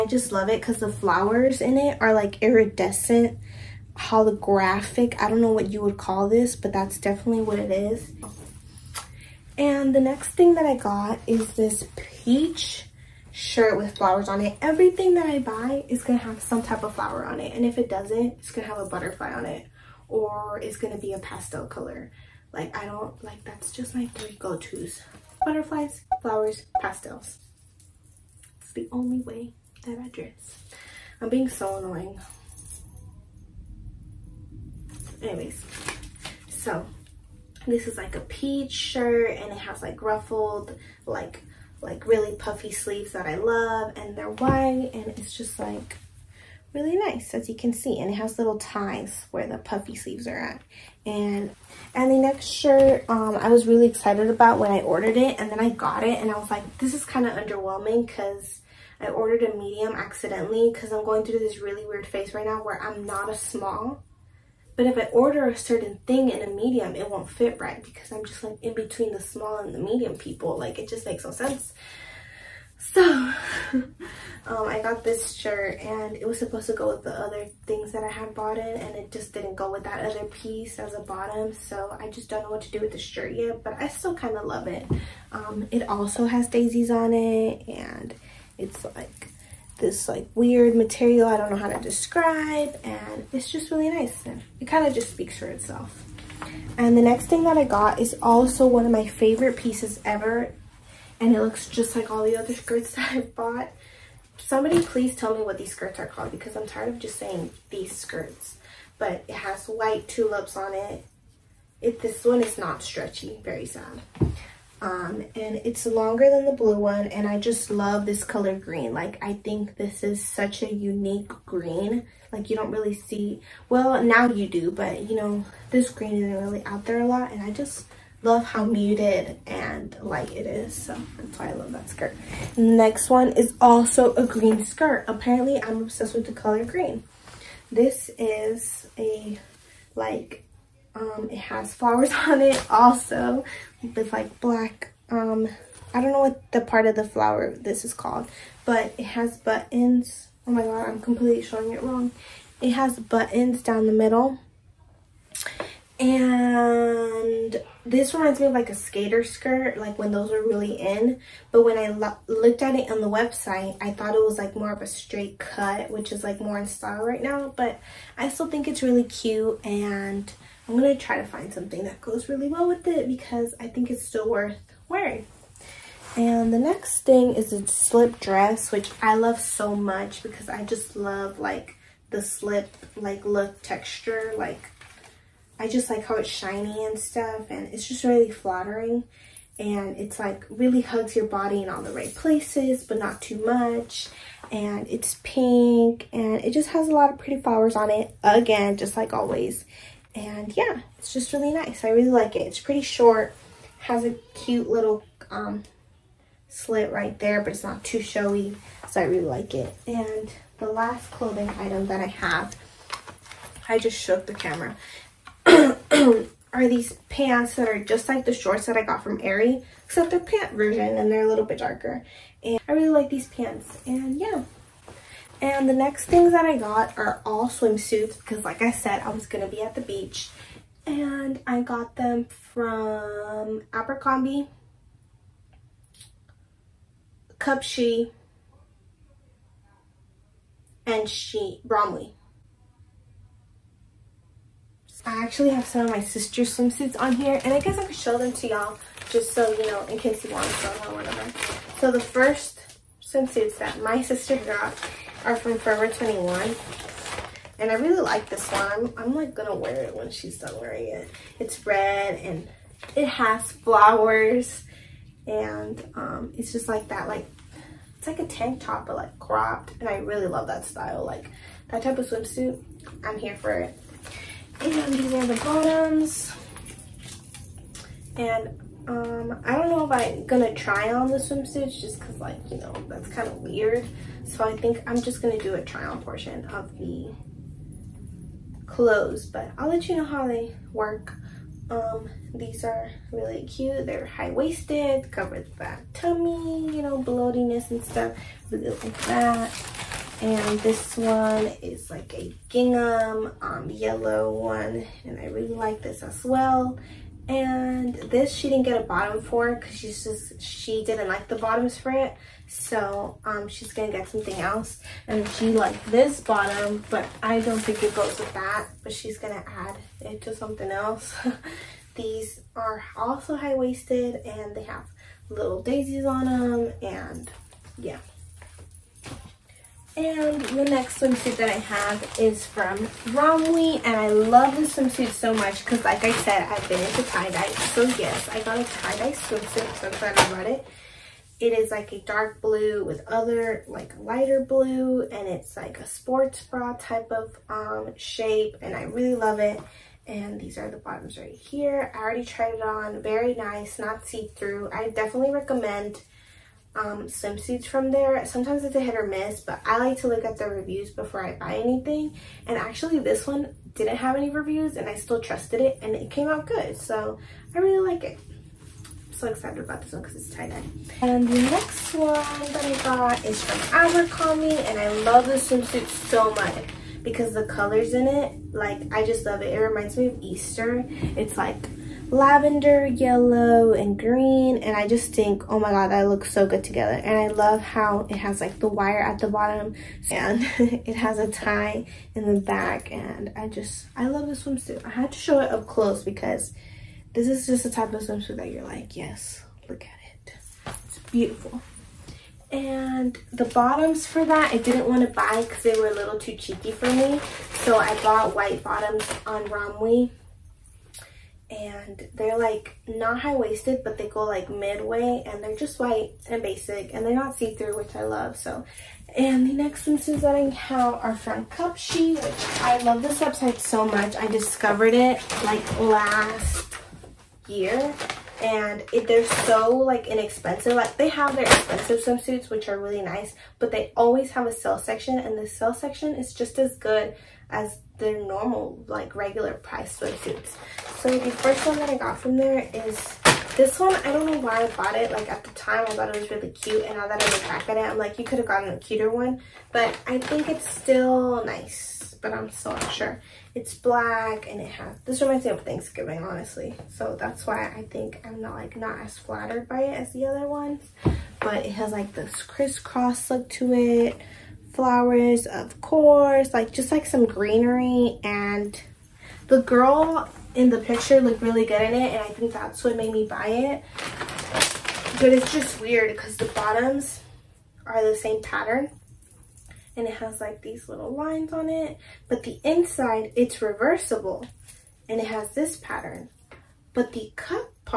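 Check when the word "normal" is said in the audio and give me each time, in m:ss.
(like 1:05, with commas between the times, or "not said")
7:18.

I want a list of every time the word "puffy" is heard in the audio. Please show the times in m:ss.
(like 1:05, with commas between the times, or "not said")
0:42, 0:49.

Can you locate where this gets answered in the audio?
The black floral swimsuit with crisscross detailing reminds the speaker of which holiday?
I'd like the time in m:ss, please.
7:35.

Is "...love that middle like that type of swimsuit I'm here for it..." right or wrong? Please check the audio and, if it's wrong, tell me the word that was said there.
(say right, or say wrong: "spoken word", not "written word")
wrong: "style", not "middle".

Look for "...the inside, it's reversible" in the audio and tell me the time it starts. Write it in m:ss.
8:02.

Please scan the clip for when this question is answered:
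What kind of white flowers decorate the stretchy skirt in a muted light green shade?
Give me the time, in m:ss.
1:49.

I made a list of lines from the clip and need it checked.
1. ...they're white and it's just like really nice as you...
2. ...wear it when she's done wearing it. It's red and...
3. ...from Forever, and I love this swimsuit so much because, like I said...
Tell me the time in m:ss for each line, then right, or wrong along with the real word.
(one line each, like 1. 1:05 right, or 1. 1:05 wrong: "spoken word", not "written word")
1. 0:44 right
2. 4:19 right
3. 5:32 wrong: "Romwe", not "Forever".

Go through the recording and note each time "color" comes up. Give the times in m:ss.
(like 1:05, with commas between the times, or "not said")
0:21, 1:58, 2:16, 6:17.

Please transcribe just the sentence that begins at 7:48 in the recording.
And the girl in the picture looked really good in it.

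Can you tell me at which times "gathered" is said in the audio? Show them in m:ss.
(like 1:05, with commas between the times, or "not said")
not said.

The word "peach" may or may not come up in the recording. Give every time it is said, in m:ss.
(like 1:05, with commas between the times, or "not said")
0:11, 0:38.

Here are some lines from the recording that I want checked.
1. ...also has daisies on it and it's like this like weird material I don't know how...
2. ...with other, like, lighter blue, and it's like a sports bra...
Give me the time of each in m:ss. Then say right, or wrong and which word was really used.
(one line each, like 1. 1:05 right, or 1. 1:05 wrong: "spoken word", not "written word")
1. 1:25 right
2. 5:42 right.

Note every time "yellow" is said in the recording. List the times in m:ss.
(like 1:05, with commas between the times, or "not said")
5:03, 6:22.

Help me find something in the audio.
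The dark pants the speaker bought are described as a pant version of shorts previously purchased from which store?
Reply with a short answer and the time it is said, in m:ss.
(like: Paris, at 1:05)
Aerie, at 3:39.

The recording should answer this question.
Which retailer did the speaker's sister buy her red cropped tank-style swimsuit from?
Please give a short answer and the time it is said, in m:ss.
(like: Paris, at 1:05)
Forever 21, at 4:15.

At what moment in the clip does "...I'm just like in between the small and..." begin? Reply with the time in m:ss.
1:08.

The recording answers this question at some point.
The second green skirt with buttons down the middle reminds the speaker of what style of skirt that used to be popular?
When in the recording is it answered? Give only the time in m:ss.
2:38.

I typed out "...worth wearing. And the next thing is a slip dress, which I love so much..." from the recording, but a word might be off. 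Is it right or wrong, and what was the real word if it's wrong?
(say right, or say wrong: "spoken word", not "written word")
right.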